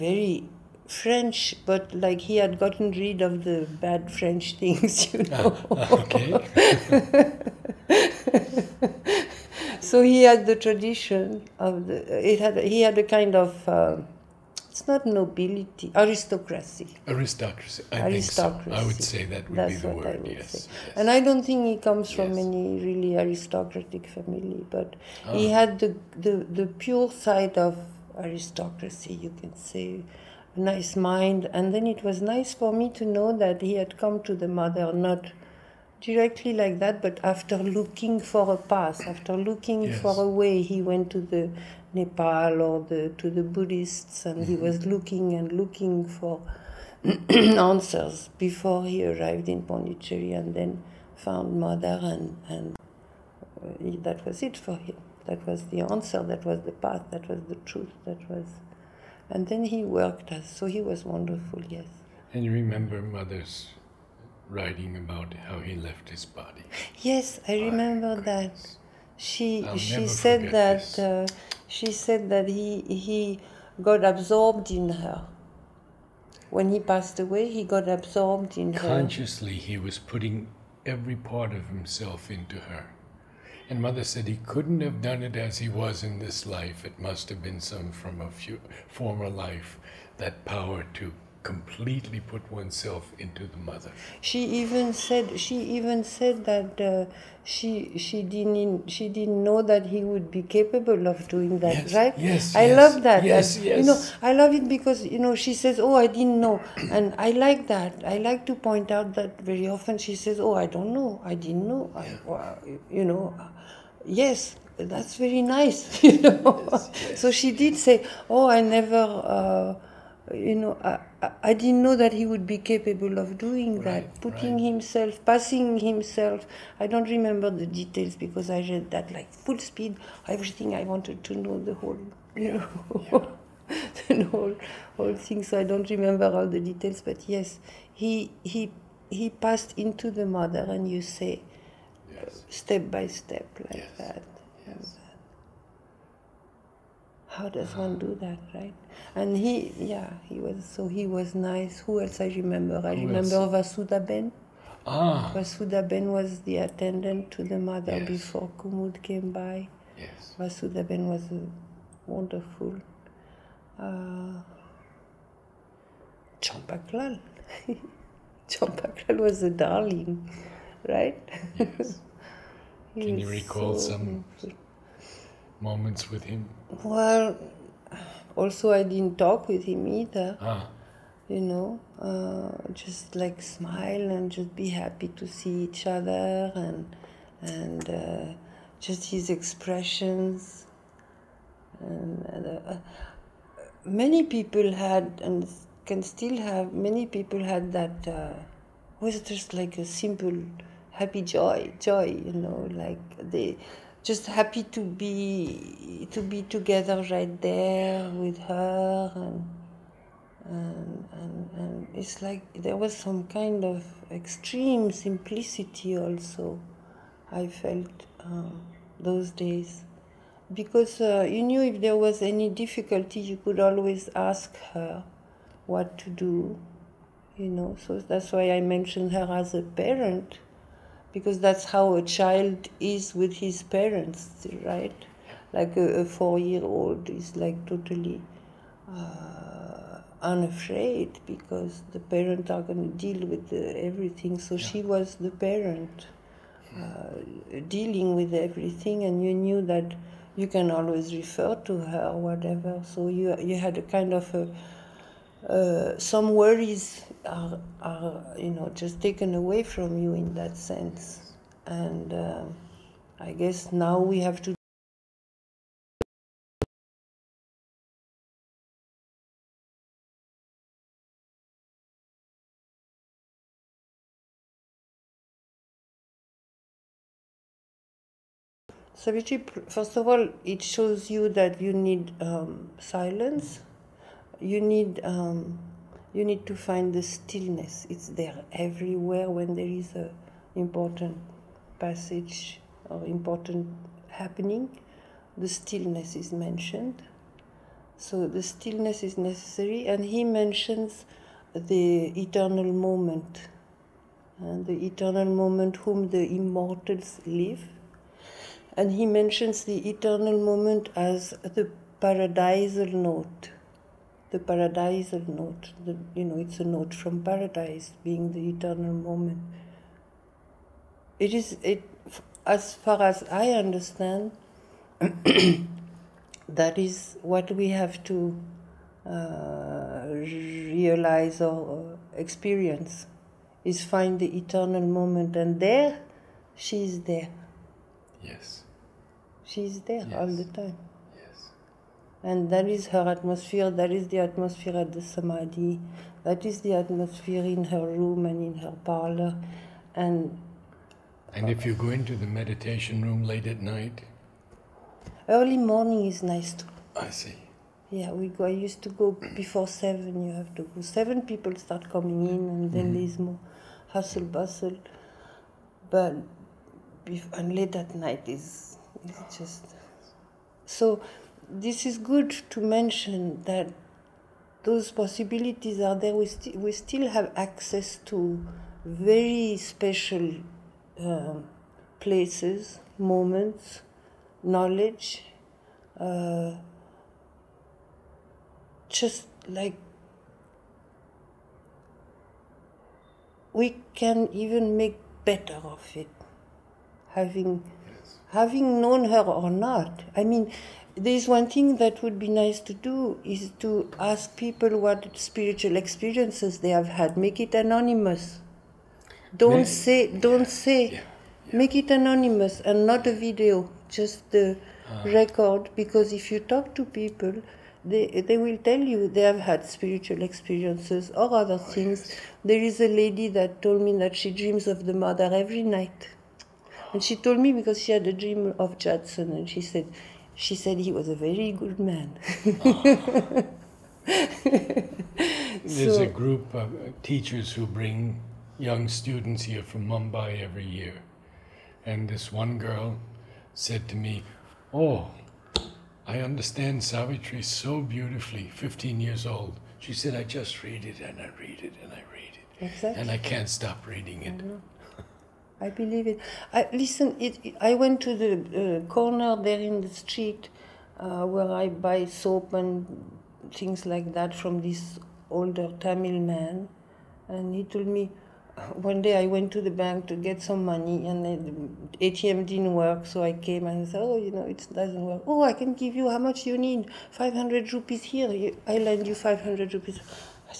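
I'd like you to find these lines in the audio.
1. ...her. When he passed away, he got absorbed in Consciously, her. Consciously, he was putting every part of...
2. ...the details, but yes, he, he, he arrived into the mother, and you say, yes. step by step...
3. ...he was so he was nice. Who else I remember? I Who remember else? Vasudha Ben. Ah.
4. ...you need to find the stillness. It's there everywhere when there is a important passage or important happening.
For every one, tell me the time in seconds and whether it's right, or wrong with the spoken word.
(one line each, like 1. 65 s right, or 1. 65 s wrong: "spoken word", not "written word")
1. 74 s right
2. 136 s wrong: "passed", not "arrived"
3. 150 s right
4. 286 s right.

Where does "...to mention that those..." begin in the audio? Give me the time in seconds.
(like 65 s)
372 s.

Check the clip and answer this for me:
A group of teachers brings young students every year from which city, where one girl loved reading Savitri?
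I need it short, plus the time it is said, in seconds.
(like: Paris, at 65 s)
Mumbai, at 439 s.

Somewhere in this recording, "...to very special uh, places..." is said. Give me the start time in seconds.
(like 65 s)
378 s.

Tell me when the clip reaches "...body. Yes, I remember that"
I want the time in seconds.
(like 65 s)
66 s.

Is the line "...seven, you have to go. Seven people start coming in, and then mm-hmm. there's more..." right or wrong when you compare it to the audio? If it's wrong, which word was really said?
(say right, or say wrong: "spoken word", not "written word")
right.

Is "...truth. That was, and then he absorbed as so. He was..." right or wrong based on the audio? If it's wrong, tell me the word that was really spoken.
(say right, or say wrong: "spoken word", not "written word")
wrong: "worked", not "absorbed".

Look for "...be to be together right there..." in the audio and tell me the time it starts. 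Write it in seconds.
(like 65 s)
204 s.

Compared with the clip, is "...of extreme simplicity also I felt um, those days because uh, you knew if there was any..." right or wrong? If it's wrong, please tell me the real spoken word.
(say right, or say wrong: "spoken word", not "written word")
right.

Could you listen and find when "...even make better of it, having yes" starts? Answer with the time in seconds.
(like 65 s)
394 s.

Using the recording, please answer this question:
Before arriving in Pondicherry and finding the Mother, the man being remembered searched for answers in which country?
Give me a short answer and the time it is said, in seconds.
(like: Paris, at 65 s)
Nepal, at 41 s.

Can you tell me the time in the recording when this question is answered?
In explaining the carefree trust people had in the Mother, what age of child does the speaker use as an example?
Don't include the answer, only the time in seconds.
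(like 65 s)
236 s.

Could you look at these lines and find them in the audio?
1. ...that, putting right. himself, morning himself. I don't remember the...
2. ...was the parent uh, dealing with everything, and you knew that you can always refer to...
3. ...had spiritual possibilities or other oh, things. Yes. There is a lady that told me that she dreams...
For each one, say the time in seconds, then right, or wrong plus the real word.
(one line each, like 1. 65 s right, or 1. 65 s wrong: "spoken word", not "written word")
1. 124 s wrong: "passing", not "morning"
2. 244 s right
3. 419 s wrong: "experiences", not "possibilities".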